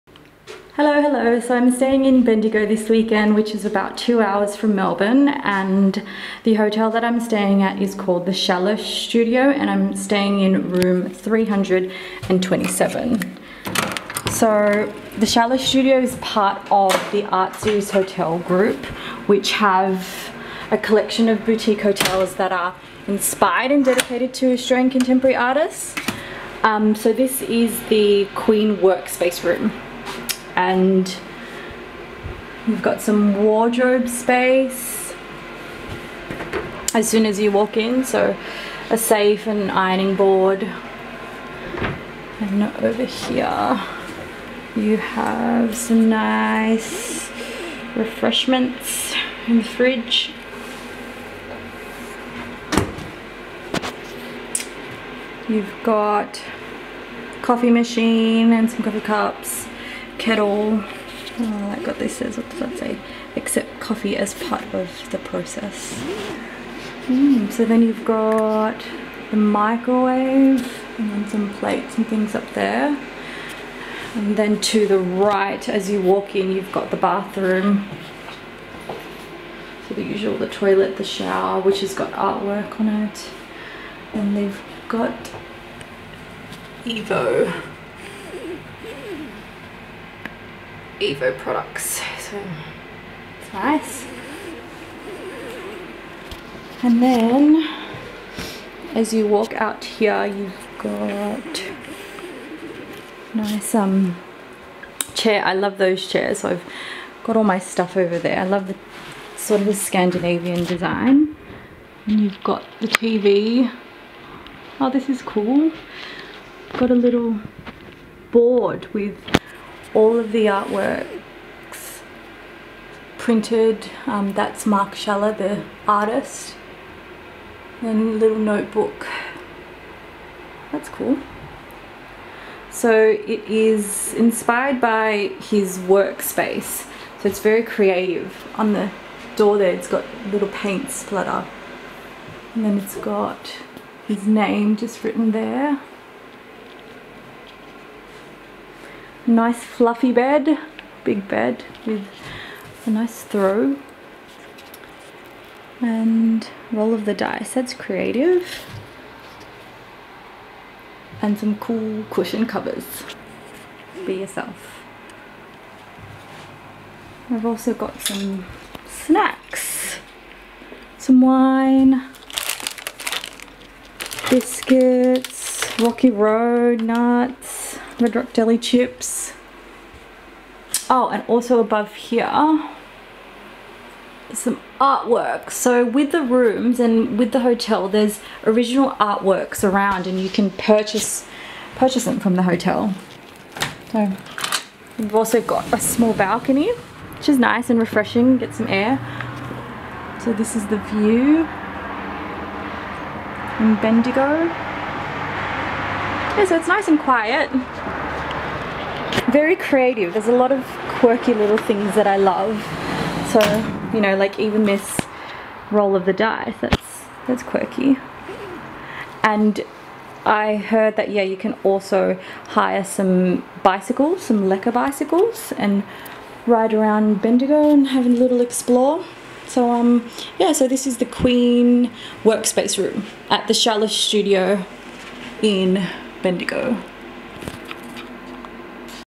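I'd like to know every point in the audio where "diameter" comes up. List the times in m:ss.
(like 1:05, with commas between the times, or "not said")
not said.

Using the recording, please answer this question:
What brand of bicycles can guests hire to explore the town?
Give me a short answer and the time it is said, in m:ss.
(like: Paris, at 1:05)
Lekker, at 3:44.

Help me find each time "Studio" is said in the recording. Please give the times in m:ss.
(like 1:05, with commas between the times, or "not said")
0:08, 0:15, 3:53.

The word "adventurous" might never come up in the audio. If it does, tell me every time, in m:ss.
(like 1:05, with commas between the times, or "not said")
not said.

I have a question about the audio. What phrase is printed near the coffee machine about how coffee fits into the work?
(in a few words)
Accept coffee as part of the process.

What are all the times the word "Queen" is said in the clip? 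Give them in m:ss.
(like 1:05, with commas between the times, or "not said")
0:28, 3:51.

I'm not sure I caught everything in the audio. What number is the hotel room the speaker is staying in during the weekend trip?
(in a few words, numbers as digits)
327.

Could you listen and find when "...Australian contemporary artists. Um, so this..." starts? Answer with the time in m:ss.
0:24.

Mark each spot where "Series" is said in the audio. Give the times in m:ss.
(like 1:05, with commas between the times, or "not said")
0:17.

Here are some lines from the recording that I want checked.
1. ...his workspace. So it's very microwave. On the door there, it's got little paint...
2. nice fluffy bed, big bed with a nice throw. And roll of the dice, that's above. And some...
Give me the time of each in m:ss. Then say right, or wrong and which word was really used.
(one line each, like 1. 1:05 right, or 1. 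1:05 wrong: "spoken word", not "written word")
1. 2:15 wrong: "creative", not "microwave"
2. 2:29 wrong: "creative", not "above".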